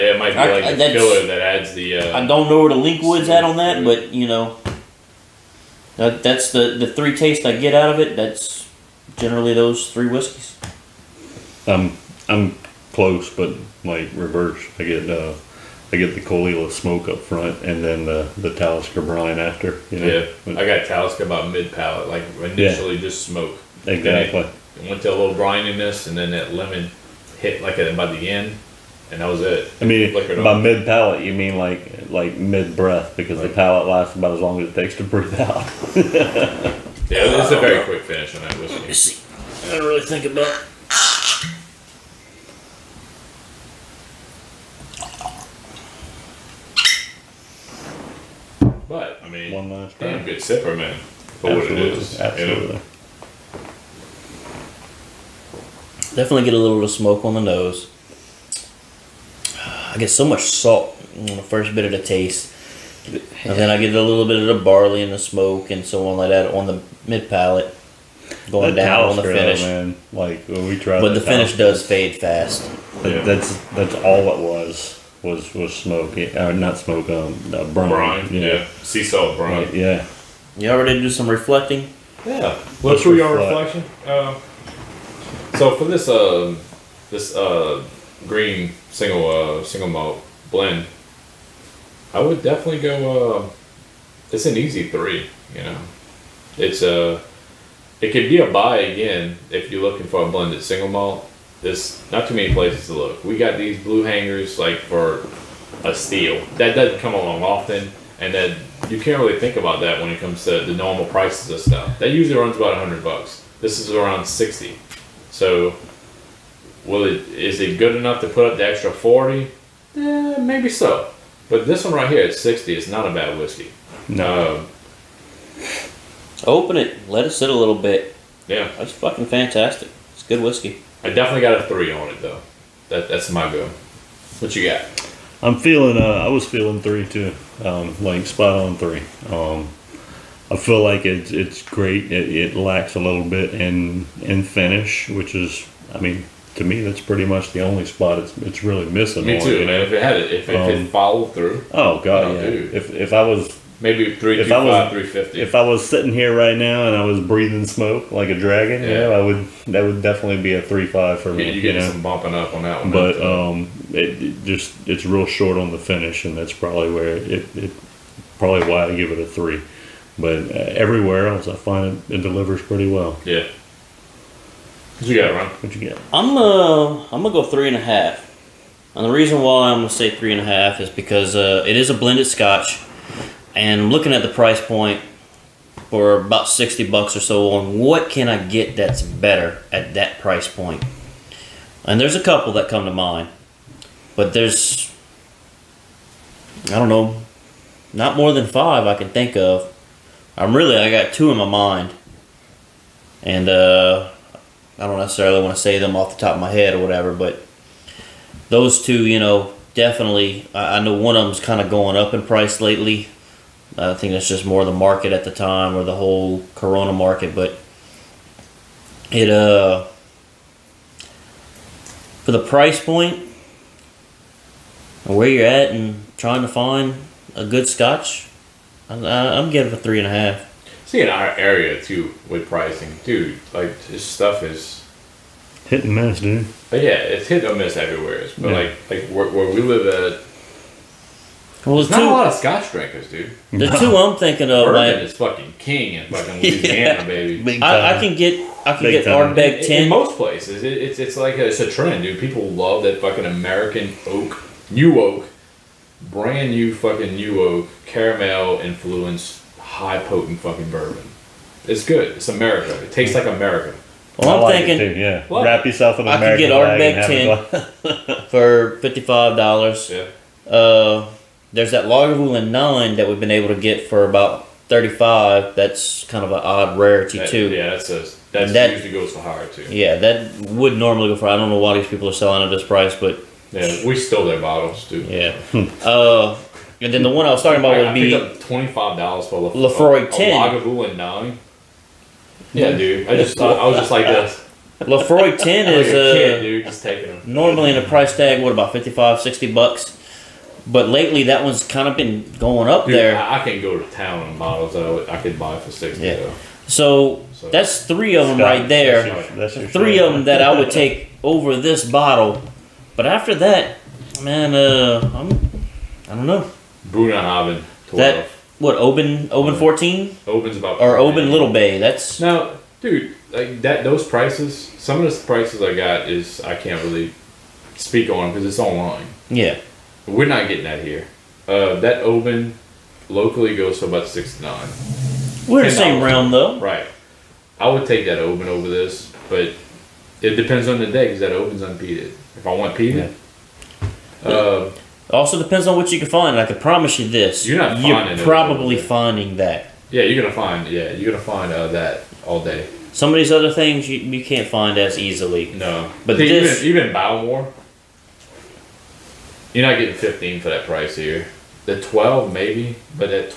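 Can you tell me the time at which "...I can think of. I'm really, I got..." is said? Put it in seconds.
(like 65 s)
198 s.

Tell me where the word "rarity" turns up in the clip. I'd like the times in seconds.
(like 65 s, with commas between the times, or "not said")
276 s.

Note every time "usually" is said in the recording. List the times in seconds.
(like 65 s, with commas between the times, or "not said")
112 s, 278 s.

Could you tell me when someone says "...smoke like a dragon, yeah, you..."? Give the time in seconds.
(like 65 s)
157 s.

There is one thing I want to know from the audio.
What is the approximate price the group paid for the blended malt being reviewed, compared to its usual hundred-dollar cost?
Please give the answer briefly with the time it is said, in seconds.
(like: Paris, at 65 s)
around $60, at 113 s.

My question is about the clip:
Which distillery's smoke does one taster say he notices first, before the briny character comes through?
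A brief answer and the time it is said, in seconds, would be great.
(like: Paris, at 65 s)
Caol Ila, at 16 s.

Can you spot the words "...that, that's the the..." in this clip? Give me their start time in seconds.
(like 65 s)
5 s.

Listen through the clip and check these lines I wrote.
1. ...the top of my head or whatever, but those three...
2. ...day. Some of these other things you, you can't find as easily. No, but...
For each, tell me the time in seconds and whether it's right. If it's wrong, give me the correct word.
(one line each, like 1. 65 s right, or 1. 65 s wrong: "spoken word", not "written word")
1. 206 s wrong: "two", not "three"
2. 352 s right.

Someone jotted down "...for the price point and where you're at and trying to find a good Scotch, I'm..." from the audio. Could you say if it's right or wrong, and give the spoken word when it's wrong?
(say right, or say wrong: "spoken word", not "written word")
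right.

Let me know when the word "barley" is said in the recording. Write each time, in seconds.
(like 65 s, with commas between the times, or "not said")
64 s.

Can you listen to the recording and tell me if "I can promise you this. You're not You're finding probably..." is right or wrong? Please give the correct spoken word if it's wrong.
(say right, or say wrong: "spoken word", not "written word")
right.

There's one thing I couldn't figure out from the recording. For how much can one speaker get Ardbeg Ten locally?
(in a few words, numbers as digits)
$55.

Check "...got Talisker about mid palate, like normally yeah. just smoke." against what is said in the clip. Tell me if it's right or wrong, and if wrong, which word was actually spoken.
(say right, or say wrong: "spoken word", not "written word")
wrong: "initially", not "normally".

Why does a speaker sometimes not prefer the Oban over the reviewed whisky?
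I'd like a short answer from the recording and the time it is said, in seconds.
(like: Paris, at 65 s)
Oban's unpeated, at 341 s.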